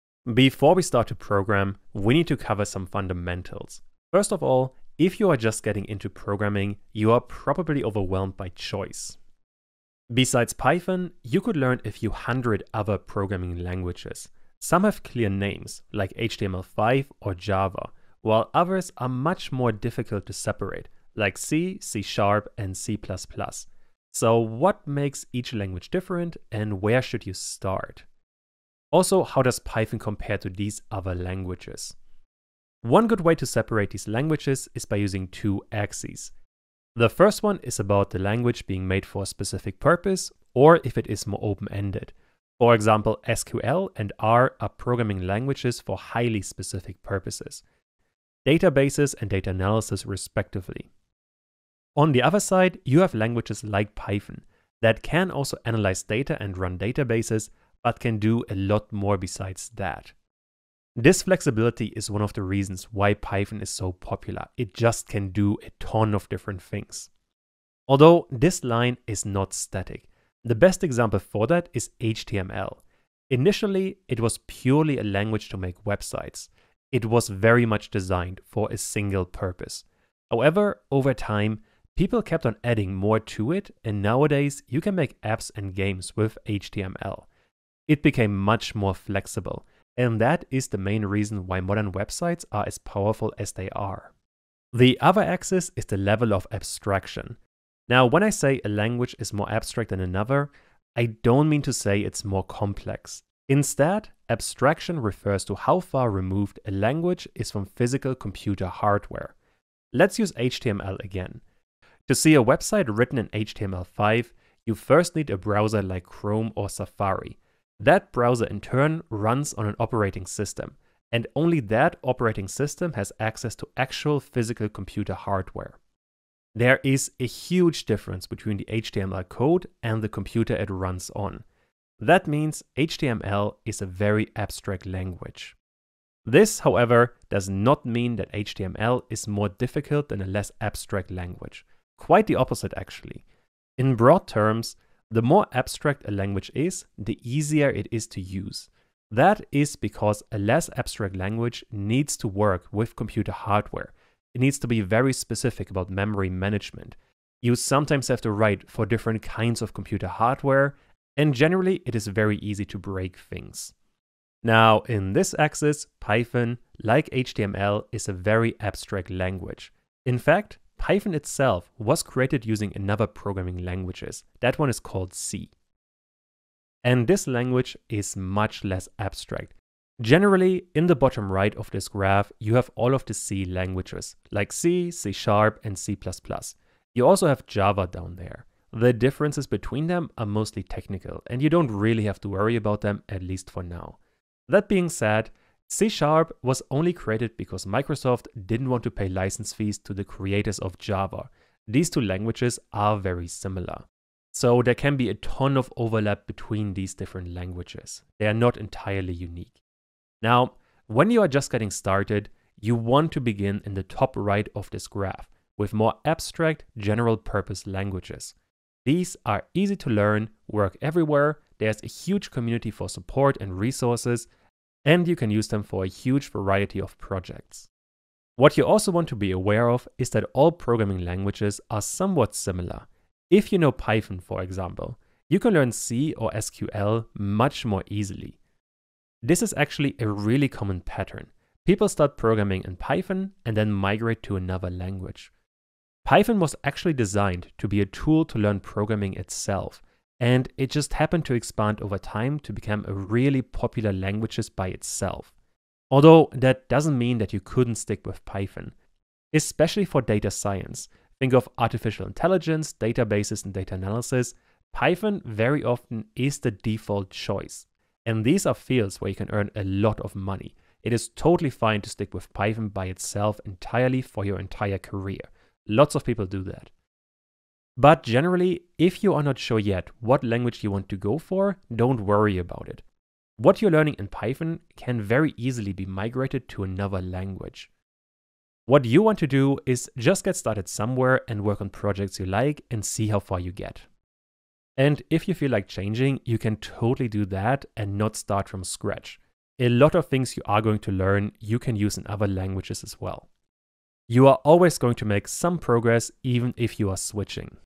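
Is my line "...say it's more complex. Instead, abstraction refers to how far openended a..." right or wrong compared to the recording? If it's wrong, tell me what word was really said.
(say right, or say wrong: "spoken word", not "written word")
wrong: "removed", not "openended".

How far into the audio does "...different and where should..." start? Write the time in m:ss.
0:25.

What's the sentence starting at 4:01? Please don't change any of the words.
People start programming in Python and then migrate to another language.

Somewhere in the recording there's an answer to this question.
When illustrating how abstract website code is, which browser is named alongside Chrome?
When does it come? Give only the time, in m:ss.
1:56.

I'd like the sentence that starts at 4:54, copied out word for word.
And if you feel like changing, you can totally do that and not start from scratch.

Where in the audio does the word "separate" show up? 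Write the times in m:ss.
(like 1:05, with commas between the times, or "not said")
0:20, 0:33.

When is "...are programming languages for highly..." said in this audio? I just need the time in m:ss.
0:44.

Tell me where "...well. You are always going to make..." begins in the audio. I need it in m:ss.
5:03.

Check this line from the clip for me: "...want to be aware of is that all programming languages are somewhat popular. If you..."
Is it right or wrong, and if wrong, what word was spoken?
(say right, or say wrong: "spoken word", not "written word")
wrong: "similar", not "popular".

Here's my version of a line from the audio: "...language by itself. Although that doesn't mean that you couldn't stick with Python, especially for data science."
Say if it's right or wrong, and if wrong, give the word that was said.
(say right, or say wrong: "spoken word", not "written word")
right.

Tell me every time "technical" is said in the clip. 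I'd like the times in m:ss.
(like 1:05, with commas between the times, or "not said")
3:10.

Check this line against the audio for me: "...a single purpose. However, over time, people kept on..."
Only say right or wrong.
right.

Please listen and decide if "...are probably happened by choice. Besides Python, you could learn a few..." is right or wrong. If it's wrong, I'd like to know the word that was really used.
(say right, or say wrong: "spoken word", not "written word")
wrong: "overwhelmed", not "happened".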